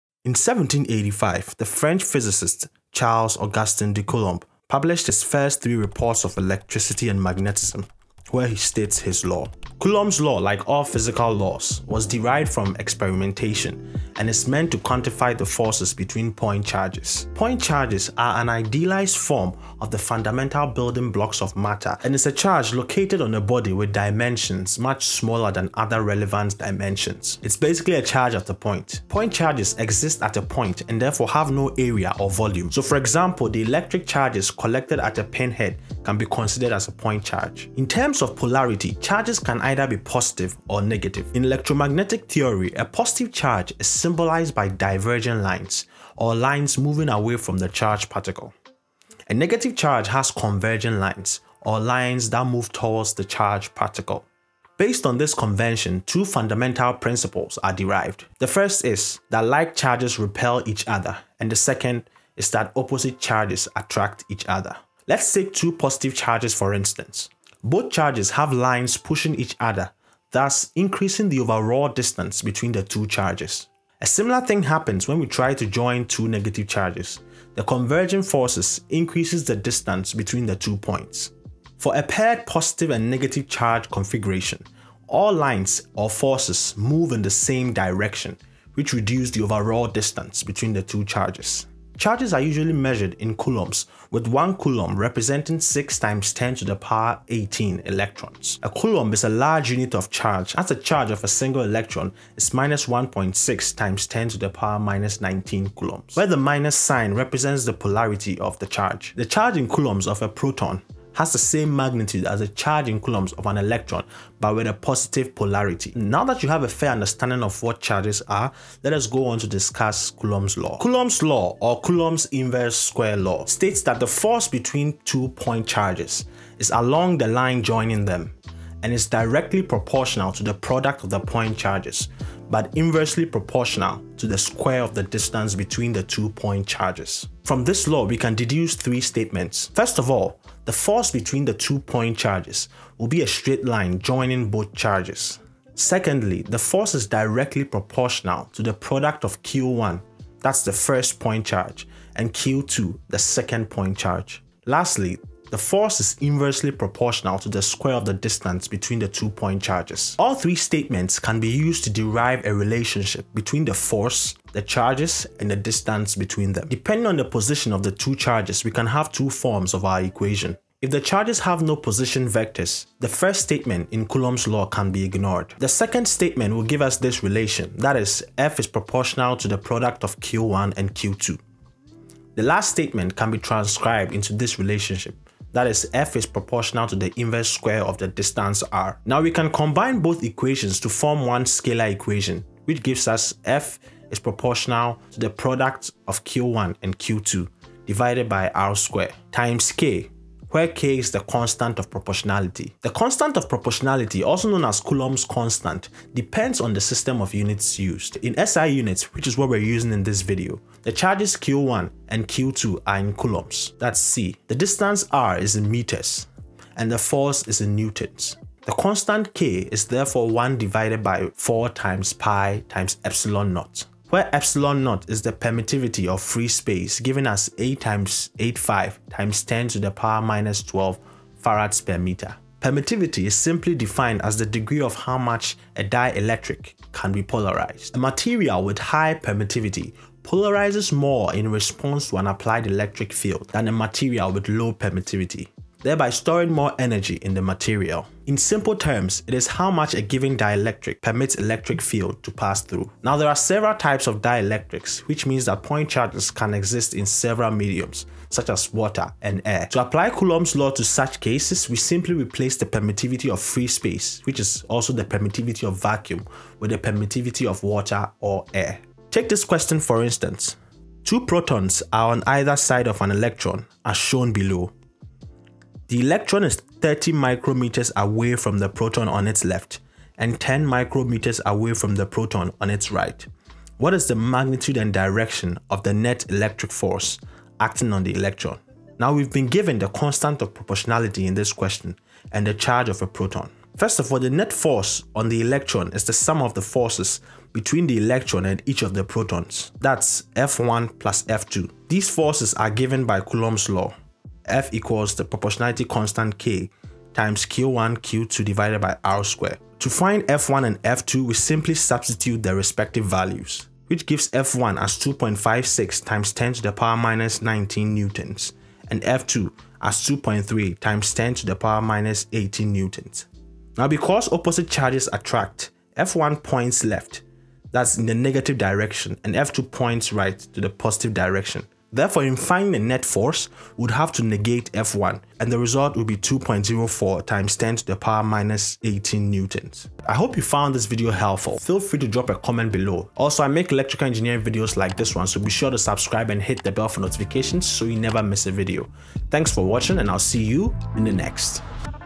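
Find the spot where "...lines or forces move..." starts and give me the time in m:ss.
1:25.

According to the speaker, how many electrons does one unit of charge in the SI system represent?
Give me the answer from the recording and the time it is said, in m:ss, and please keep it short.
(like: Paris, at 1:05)
6 x 10^18, at 1:35.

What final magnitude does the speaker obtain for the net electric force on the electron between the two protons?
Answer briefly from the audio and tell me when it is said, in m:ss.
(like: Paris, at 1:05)
2.04 x 10^-18 newtons, at 5:36.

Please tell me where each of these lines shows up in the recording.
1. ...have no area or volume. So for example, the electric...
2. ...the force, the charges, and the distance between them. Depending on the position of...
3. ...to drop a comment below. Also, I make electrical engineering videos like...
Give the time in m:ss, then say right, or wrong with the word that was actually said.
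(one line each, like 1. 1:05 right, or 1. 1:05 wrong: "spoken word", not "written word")
1. 0:31 right
2. 2:43 right
3. 5:41 right.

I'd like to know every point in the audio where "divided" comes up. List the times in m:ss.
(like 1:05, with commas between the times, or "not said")
3:17, 3:40, 5:08.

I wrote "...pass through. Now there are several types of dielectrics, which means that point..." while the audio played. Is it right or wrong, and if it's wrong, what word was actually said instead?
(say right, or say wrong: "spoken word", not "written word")
right.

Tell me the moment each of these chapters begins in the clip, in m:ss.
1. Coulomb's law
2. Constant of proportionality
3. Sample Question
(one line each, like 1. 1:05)
1. 2:00
2. 3:23
3. 4:29.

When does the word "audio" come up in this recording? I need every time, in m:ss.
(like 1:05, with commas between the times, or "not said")
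not said.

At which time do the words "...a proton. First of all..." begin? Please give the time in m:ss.
4:53.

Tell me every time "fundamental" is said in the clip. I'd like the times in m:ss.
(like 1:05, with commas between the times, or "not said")
0:19, 0:56.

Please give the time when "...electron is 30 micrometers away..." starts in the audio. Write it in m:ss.
4:35.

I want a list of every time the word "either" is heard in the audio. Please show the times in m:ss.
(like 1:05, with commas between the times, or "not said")
0:39, 4:32.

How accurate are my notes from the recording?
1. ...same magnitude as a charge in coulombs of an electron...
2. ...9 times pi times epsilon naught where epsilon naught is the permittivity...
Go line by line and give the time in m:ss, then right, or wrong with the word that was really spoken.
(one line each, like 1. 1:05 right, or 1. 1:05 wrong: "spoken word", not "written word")
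1. 1:51 right
2. 3:41 wrong: "4", not "9".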